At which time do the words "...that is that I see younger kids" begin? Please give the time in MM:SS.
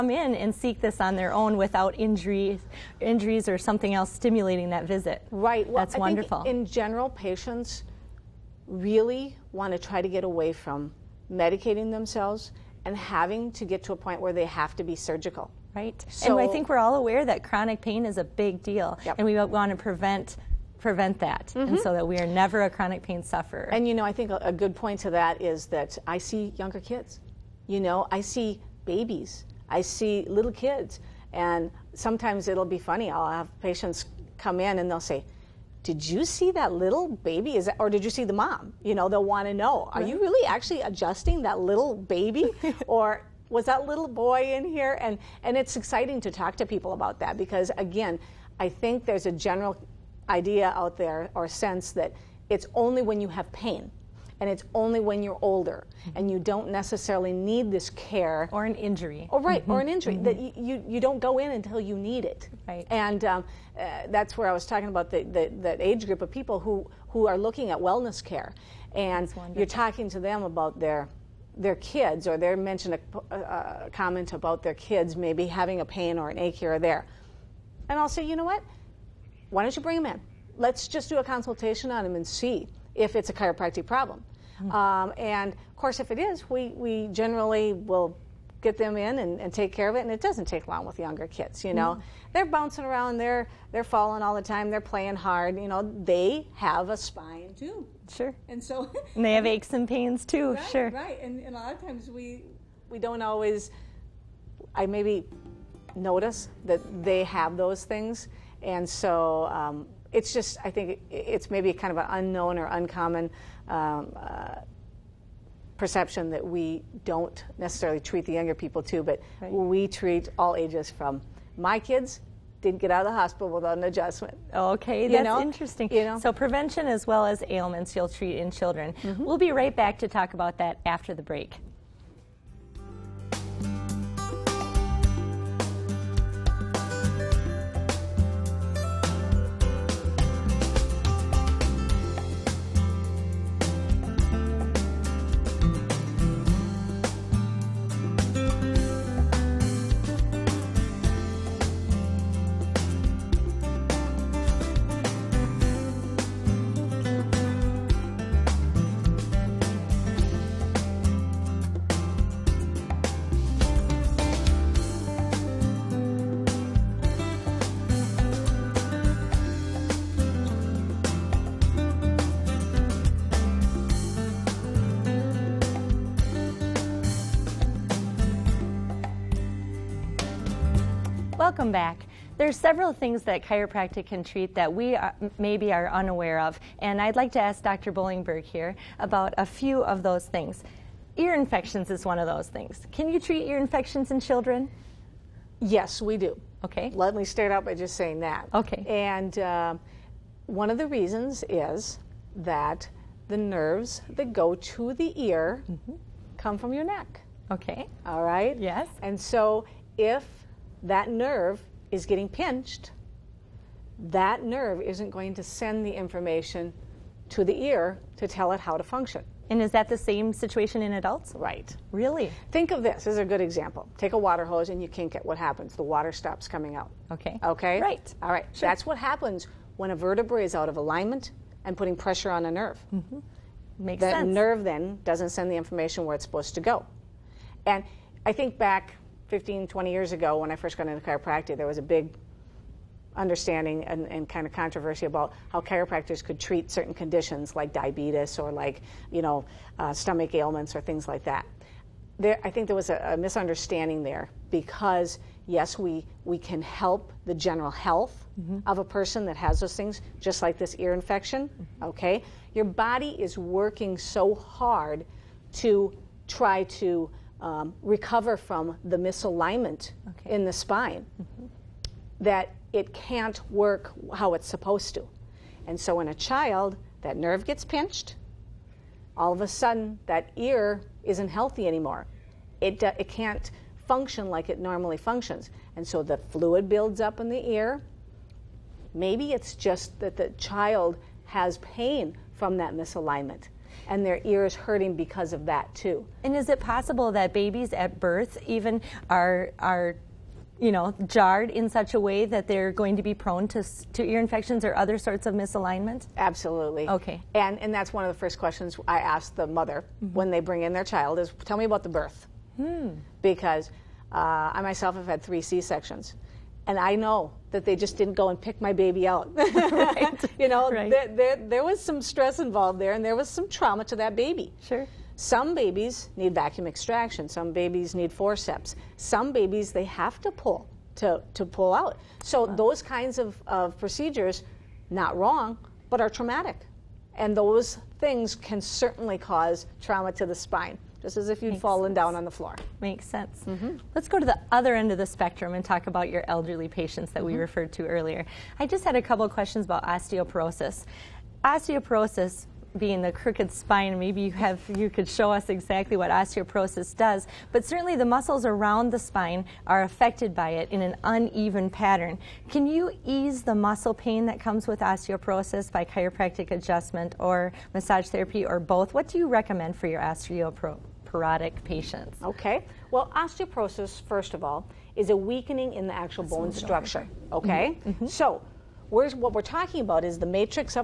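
00:25.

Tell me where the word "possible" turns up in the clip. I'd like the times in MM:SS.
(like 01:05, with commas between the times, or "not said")
04:56.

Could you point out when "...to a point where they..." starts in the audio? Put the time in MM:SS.
00:13.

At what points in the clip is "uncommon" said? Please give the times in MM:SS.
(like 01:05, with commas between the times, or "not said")
01:52.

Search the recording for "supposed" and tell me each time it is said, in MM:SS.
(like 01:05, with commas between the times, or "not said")
03:56, 04:34.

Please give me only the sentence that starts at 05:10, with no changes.
when they bring in their child is, tell me about the birth.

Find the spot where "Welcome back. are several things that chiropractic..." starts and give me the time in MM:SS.
03:01.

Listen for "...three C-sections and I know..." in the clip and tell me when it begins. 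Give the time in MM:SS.
05:15.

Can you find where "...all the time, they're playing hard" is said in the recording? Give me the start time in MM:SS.
01:34.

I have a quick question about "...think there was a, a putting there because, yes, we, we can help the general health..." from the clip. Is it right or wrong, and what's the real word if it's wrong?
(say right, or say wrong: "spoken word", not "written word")
wrong: "misunderstanding", not "putting".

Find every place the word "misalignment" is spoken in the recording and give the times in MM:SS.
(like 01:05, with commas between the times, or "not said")
04:28, 04:52, 05:05.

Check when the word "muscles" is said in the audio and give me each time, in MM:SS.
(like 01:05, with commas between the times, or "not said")
05:58, 06:03.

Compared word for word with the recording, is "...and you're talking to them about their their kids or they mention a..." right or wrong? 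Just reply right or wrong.
right.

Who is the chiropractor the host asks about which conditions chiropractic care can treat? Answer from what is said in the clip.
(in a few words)
Dr. Bollingberg.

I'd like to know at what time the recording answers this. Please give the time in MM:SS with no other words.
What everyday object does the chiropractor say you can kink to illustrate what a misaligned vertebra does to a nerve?
03:44.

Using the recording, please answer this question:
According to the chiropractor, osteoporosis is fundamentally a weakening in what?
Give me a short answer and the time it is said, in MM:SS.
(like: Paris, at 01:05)
Bone structure, at 06:16.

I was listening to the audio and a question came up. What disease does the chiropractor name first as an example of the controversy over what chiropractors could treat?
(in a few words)
Diabetes.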